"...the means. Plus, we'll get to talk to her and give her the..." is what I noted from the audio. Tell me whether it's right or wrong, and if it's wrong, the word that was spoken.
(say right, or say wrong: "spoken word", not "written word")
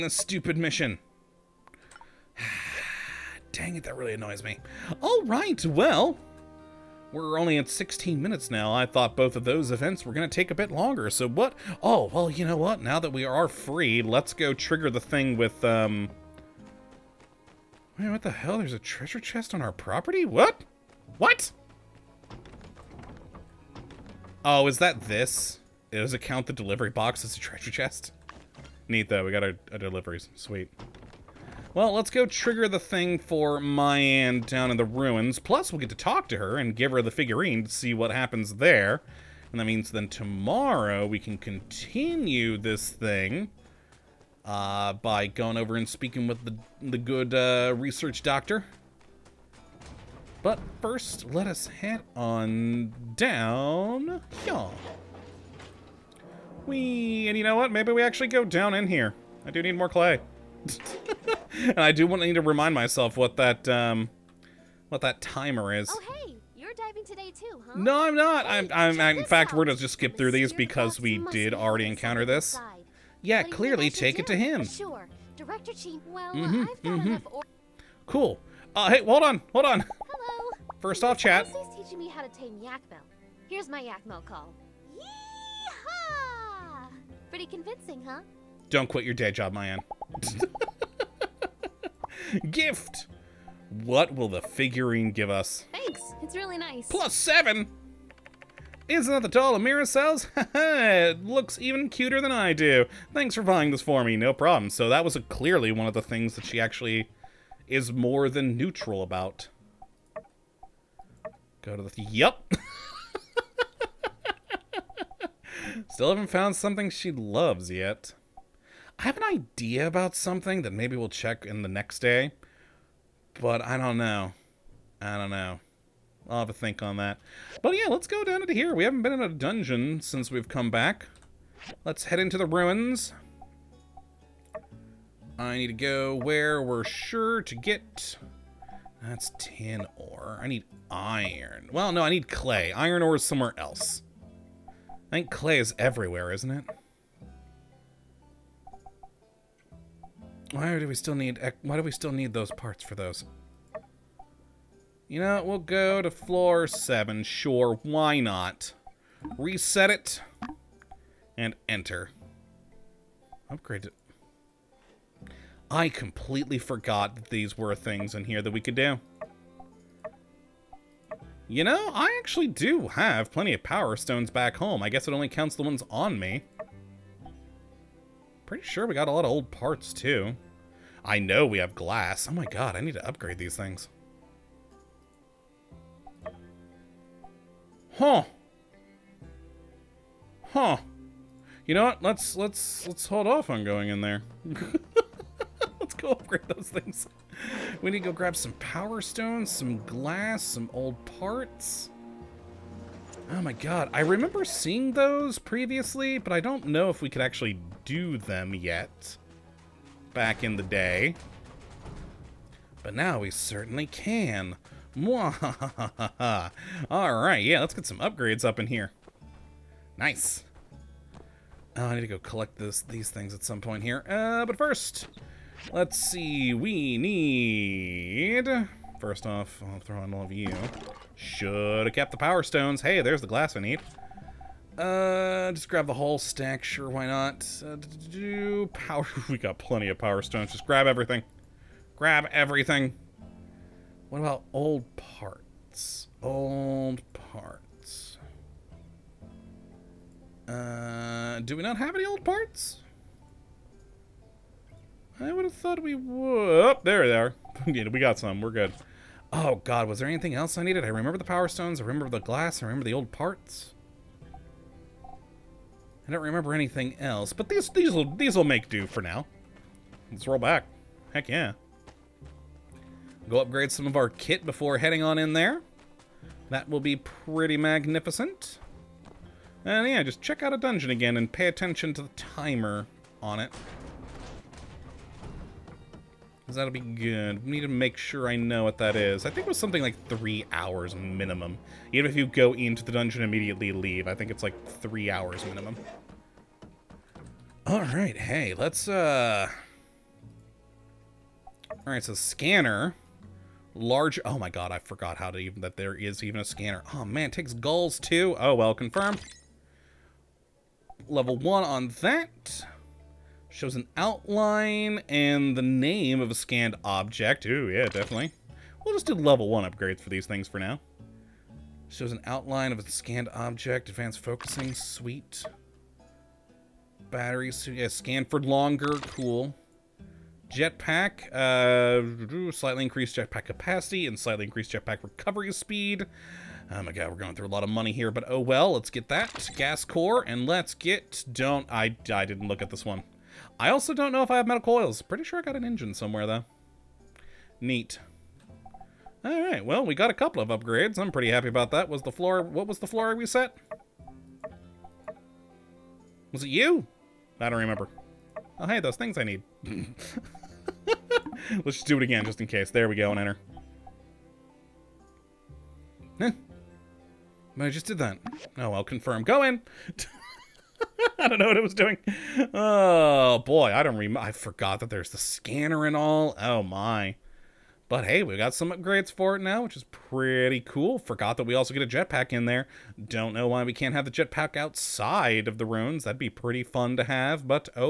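wrong: "ruins", not "means".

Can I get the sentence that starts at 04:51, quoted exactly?
Even if you go into the dungeon immediately leave, I think it's like three hours minimum.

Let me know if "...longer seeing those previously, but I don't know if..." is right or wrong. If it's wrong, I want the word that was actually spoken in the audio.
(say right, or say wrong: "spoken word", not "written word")
wrong: "remember", not "longer".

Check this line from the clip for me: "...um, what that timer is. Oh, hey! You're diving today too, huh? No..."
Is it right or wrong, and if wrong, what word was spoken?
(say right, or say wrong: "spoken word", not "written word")
right.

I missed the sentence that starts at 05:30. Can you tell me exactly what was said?
Jetpack, uh, slightly increased jetpack capacity and slightly increased jetpack recovery speed.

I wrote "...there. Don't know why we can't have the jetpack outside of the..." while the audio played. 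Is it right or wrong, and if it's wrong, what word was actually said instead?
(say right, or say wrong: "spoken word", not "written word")
right.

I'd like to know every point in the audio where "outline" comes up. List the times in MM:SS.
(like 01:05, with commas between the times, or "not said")
05:13, 05:22.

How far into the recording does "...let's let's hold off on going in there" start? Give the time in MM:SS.
03:12.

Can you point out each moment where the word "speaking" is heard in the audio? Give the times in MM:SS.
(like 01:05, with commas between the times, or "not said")
00:45.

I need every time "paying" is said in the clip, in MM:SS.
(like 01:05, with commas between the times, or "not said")
not said.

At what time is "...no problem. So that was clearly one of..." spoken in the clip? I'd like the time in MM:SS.
01:44.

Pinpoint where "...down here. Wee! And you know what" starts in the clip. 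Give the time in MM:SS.
00:53.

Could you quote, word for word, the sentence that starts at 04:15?
I would have thought we would.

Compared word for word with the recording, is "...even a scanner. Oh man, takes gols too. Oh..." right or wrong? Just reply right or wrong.
right.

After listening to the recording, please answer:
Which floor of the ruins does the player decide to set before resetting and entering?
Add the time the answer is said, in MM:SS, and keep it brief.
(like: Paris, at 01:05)
Floor 7, at 02:36.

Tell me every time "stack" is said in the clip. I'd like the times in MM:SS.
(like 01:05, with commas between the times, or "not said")
03:56.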